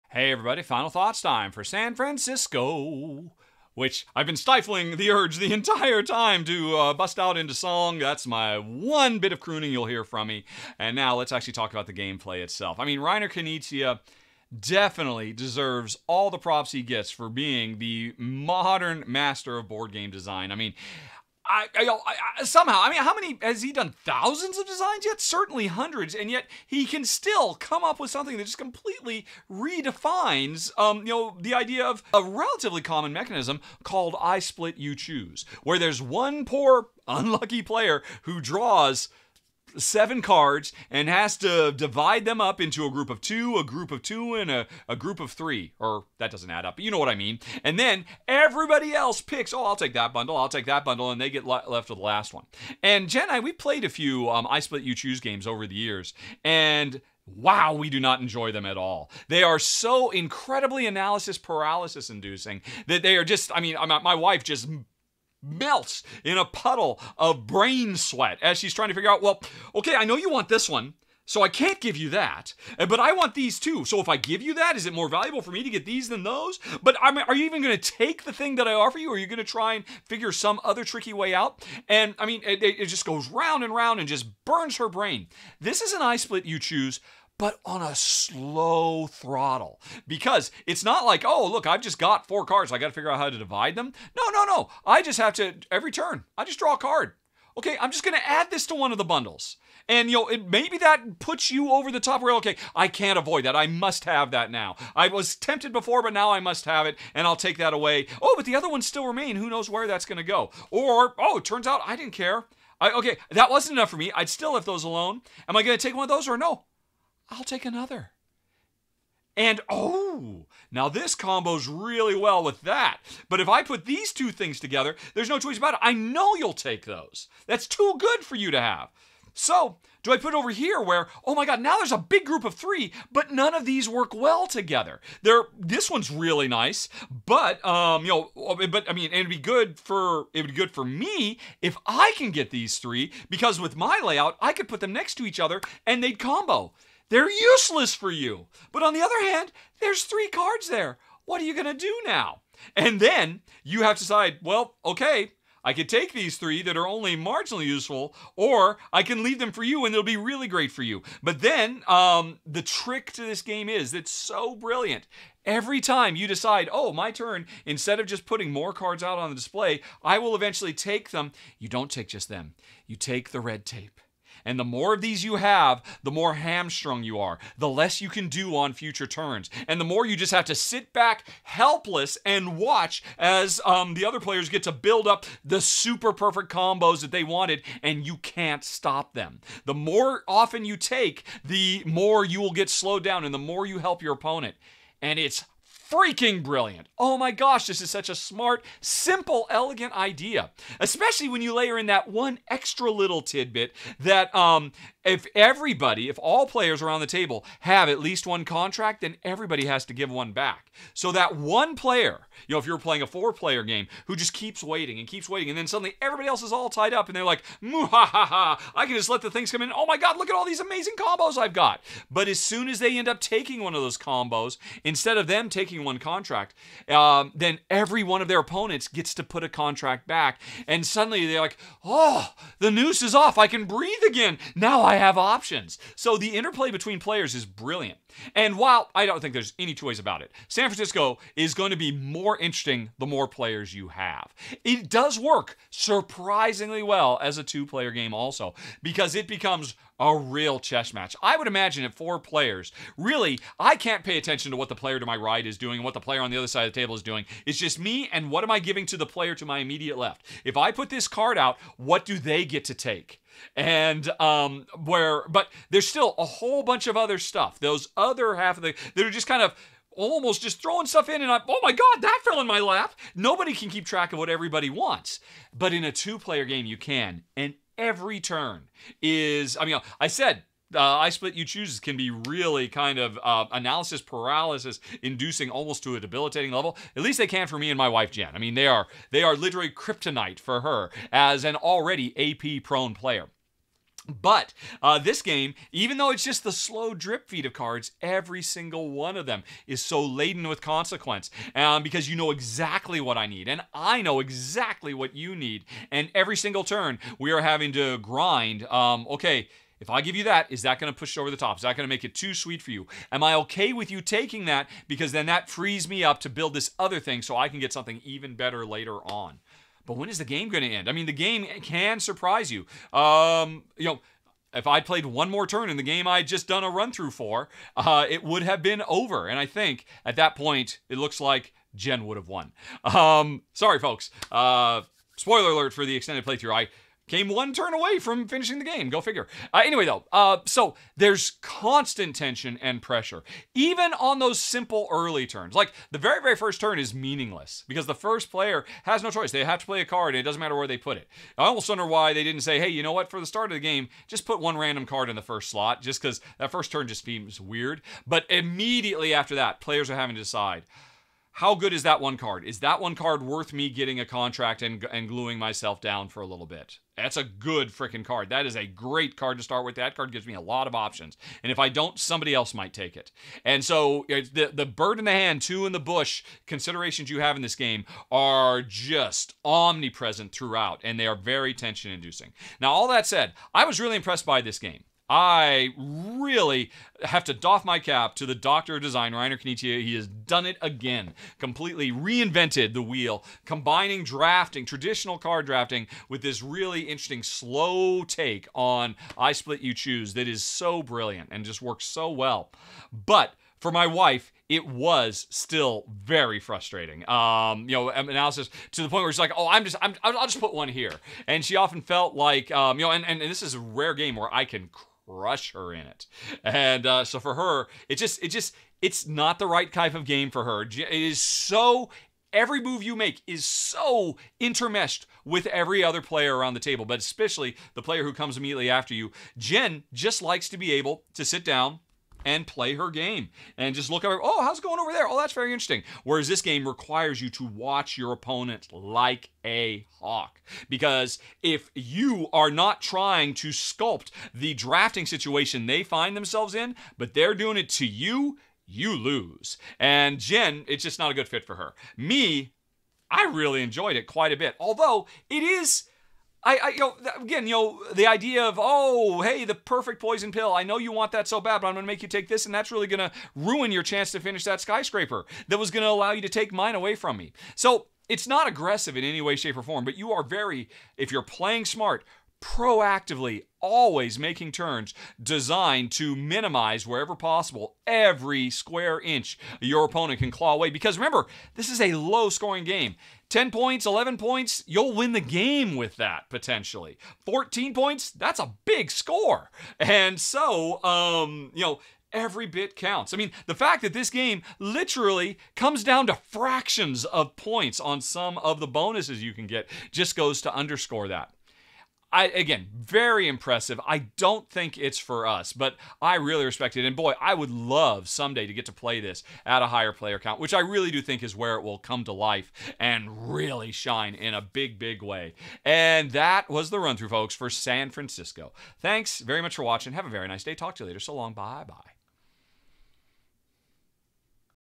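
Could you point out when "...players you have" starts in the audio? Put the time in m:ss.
4:03.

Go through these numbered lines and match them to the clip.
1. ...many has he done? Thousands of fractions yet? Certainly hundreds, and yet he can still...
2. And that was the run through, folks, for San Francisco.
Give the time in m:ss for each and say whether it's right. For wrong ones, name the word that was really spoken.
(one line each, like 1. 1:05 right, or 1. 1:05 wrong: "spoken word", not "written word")
1. 0:23 wrong: "designs", not "fractions"
2. 8:35 right.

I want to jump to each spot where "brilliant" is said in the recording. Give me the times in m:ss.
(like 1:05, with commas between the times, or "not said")
2:44, 3:16, 3:57, 6:40.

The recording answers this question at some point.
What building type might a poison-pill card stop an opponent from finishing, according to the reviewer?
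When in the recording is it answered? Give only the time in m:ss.
7:44.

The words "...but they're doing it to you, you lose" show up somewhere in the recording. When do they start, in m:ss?
7:26.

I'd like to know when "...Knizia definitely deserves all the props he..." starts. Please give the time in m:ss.
0:13.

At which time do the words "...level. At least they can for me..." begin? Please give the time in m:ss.
4:46.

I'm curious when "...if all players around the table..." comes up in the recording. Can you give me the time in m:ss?
3:26.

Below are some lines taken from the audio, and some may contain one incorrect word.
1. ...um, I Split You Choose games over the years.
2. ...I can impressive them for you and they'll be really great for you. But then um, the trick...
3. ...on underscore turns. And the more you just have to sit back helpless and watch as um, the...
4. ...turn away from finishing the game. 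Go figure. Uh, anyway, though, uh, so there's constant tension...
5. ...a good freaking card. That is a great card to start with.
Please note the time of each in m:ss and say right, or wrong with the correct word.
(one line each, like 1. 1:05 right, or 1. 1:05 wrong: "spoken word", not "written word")
1. 0:54 right
2. 2:38 wrong: "leave", not "impressive"
3. 2:58 wrong: "future", not "underscore"
4. 5:37 right
5. 6:07 right.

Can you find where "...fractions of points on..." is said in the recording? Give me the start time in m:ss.
8:16.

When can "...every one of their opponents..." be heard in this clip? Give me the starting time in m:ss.
3:47.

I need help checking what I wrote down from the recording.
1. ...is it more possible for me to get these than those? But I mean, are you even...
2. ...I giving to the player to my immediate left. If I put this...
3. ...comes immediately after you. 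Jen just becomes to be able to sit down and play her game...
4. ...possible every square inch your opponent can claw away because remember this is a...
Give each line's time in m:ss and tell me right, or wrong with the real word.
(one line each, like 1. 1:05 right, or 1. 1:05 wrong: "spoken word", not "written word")
1. 1:14 wrong: "valuable", not "possible"
2. 4:18 right
3. 7:08 wrong: "likes", not "becomes"
4. 7:57 right.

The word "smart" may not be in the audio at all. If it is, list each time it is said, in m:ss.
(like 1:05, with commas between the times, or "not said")
3:18, 7:51.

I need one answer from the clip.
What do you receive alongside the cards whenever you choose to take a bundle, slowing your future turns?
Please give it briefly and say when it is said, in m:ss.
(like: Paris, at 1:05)
the red tape, at 2:53.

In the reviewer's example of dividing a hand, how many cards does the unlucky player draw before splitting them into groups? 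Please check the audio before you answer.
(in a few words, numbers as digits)
7.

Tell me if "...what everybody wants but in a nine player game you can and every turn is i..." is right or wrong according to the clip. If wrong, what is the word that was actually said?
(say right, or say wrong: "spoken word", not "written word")
wrong: "two", not "nine".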